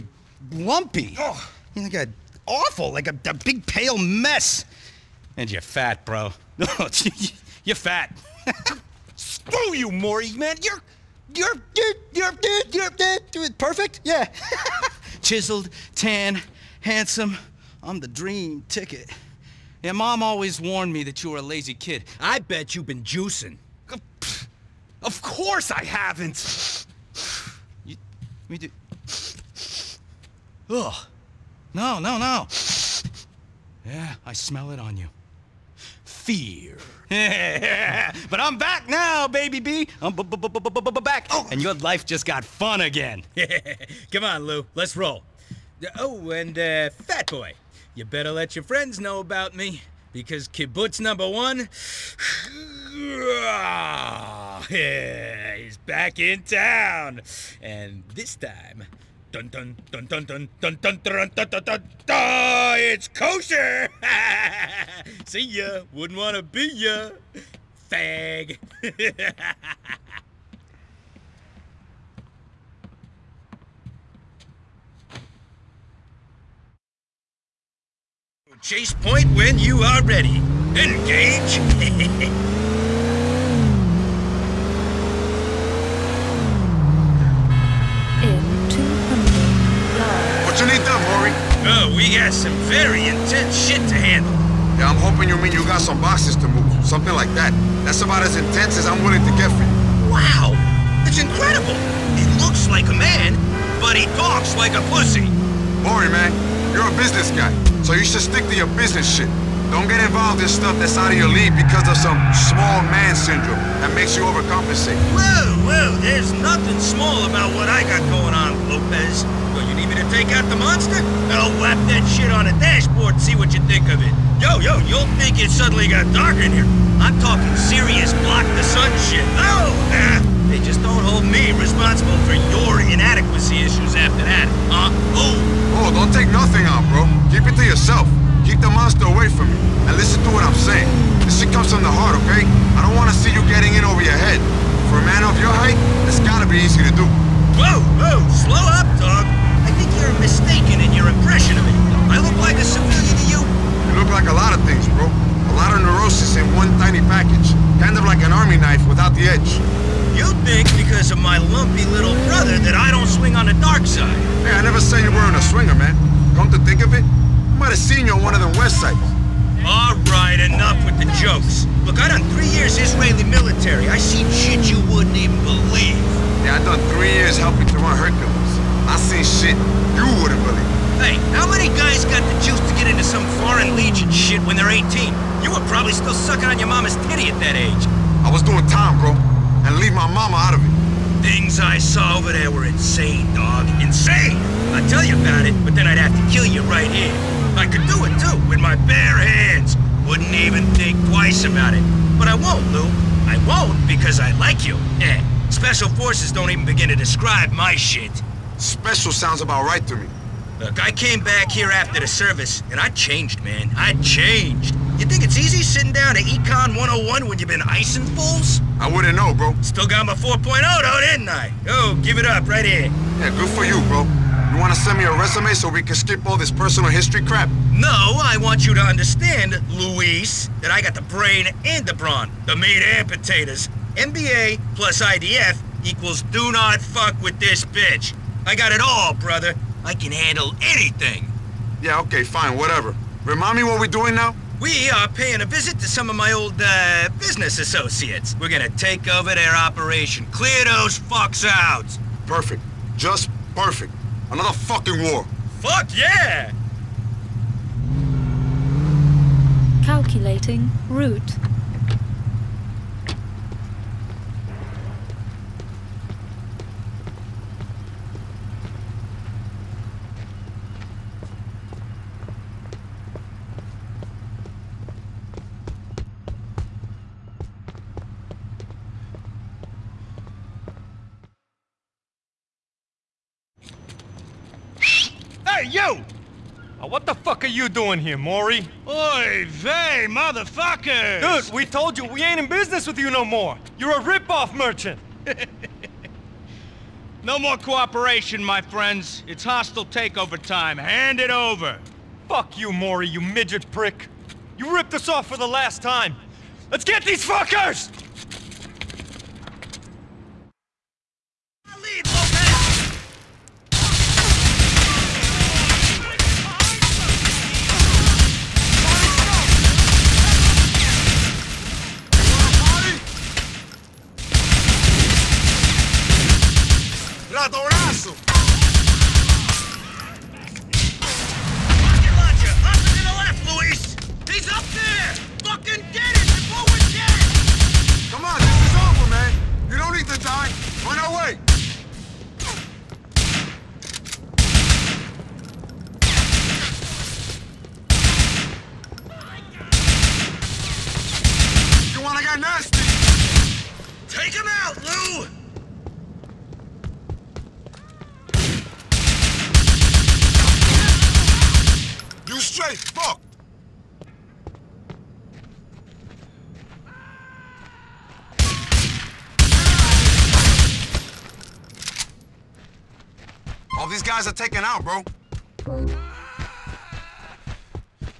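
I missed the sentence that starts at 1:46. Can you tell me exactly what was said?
You're a business guy, so you should stick to your business shit.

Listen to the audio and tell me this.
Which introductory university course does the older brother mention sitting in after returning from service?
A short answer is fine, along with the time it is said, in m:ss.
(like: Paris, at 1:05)
Econ 101, at 3:36.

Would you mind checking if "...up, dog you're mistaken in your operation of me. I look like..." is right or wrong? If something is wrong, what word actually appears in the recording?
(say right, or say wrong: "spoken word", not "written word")
wrong: "impression", not "operation".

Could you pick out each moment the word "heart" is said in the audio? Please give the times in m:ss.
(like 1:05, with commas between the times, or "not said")
2:21.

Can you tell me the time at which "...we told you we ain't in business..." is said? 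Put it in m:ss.
4:51.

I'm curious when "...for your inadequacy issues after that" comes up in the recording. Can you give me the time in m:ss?
2:12.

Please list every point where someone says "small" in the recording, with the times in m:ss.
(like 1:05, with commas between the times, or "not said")
1:52, 1:56.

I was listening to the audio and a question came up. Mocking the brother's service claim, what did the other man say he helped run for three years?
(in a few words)
Hercules.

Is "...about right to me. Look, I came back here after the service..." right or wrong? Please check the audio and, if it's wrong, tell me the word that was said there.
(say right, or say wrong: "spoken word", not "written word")
right.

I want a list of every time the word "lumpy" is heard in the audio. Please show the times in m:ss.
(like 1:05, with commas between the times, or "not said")
0:00, 2:41.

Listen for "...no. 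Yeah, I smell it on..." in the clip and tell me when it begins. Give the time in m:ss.
0:32.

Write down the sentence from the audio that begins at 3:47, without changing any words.
No, I want you to understand, Luis, that I got the brain and the brawn, the meat and potatoes.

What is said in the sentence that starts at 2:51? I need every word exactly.
Look, I done three years Israeli military.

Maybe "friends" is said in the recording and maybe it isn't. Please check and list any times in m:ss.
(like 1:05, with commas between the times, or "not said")
0:48, 4:58.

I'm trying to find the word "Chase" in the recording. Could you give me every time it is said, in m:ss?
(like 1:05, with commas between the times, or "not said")
1:18.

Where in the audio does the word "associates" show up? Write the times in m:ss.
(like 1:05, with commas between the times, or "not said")
4:07.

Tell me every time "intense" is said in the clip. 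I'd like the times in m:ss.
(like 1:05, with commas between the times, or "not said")
1:33, 1:38.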